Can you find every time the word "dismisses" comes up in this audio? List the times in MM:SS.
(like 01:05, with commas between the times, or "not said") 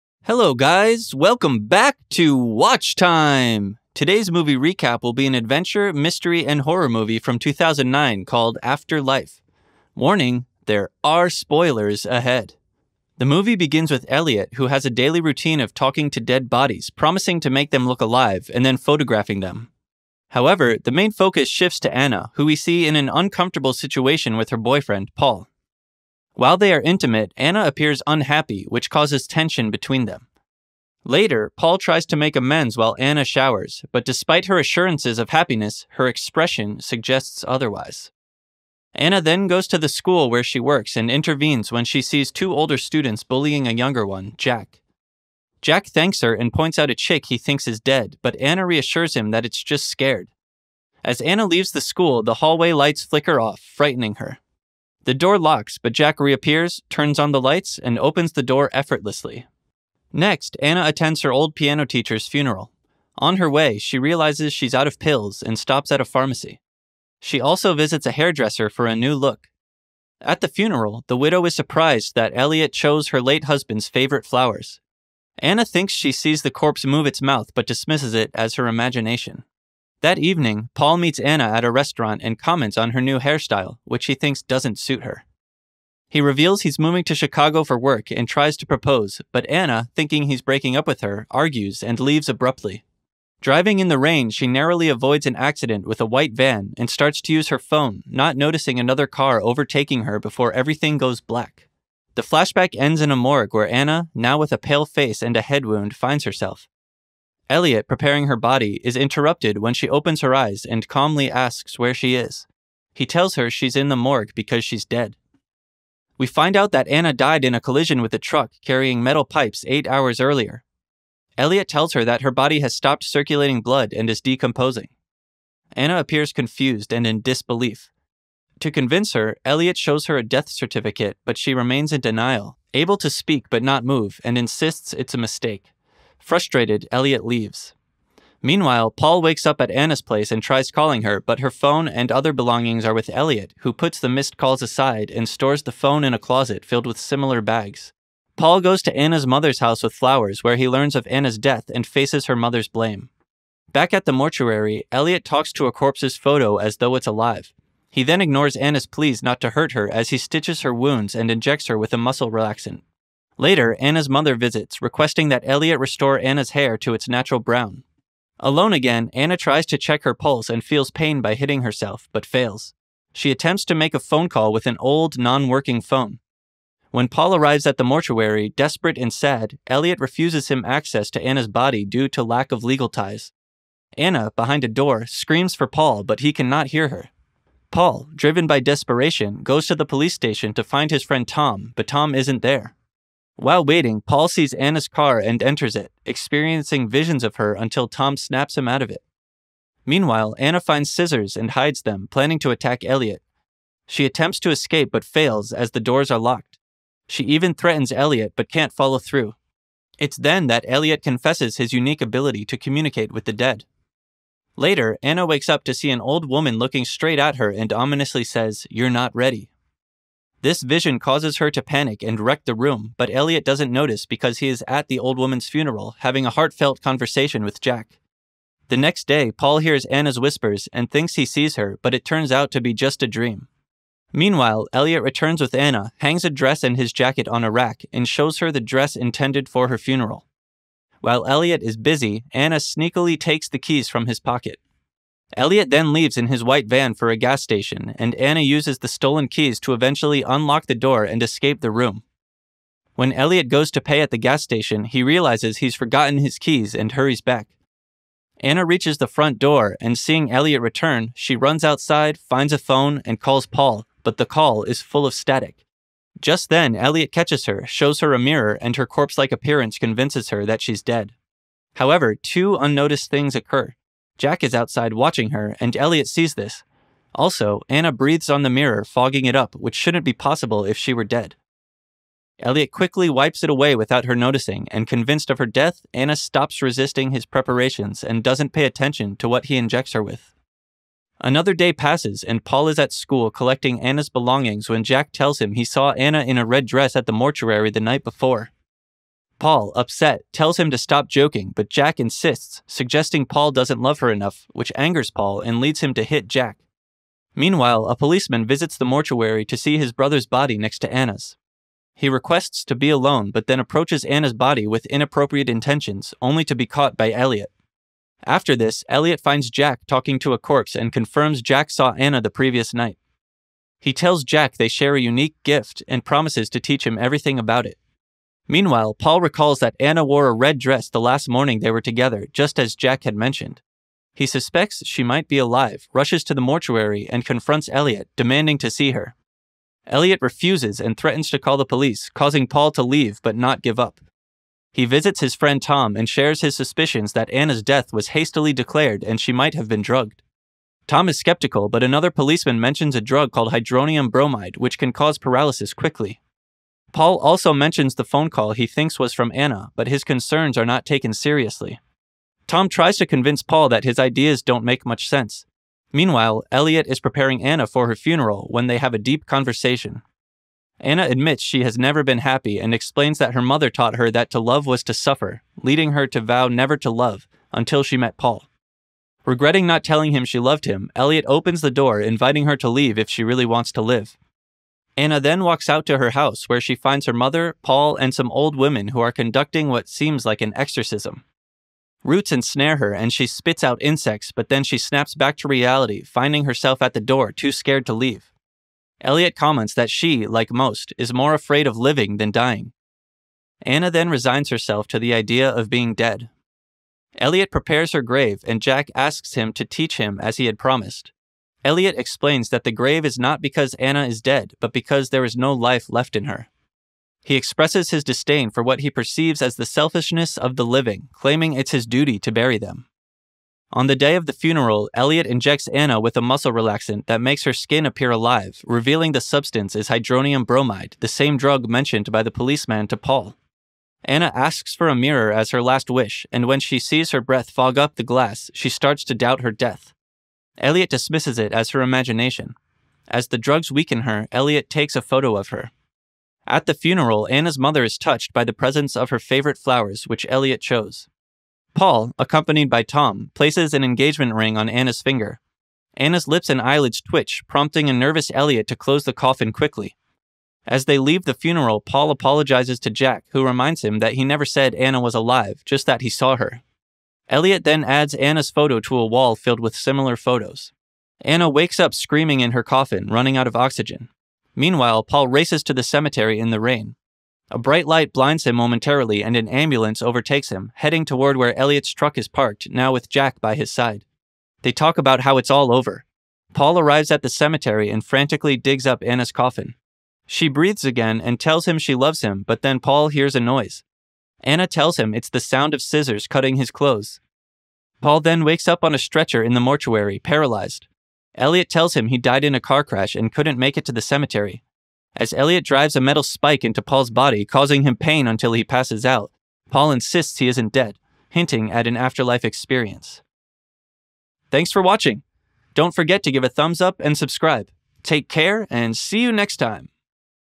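01:17, 07:20.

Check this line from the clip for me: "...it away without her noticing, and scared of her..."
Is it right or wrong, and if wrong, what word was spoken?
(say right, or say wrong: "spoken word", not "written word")
wrong: "convinced", not "scared".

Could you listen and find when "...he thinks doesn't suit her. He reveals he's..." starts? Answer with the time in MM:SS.
01:24.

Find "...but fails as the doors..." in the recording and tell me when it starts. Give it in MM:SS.
03:24.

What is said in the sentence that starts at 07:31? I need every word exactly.
Paul, accompanied by Tom, places an engagement ring on Anna's finger.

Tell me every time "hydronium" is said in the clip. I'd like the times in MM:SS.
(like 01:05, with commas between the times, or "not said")
05:53, 07:09.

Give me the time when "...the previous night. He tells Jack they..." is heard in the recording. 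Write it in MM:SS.
05:22.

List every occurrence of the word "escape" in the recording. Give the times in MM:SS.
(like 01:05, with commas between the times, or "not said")
03:24, 04:11.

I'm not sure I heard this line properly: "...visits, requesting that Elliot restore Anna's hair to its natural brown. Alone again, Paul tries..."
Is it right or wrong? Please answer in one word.
wrong.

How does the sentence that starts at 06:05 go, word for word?
Meanwhile, Elliot is preparing Anna for her funeral when they have a deep conversation.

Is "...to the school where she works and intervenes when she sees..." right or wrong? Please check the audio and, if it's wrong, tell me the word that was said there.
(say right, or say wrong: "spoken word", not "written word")
right.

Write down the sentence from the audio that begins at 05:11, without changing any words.
He requests to be alone, but then approaches Anna's body with inappropriate intentions, only to be caught by Elliot.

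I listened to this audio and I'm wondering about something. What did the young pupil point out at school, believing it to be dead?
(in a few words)
A chick.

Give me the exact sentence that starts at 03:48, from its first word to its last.
The next day, Paul hears Anna's whispers and thinks he sees her, but it turns out to be just a dream.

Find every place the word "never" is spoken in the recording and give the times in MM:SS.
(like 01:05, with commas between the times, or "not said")
06:11, 06:16, 07:44.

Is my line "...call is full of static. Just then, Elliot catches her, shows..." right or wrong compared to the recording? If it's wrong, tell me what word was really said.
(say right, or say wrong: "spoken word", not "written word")
right.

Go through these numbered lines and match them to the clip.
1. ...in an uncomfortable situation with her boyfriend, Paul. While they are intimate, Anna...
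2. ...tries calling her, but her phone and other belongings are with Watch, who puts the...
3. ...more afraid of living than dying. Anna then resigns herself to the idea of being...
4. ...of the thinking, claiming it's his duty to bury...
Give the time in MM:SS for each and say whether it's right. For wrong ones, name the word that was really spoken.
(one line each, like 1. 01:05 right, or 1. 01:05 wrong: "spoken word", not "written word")
1. 00:22 right
2. 02:20 wrong: "Elliot", not "Watch"
3. 06:41 right
4. 07:00 wrong: "living", not "thinking".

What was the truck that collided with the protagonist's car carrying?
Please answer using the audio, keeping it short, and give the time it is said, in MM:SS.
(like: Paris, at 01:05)
Metal pipes, at 01:59.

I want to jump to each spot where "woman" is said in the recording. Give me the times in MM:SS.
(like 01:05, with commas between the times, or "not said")
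03:36, 03:45.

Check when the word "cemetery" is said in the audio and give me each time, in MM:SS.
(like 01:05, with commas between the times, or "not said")
07:55, 08:07, 08:24.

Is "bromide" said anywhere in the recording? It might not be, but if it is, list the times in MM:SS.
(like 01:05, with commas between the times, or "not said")
05:54, 07:10.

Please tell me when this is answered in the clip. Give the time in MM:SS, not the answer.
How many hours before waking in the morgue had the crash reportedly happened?
01:59.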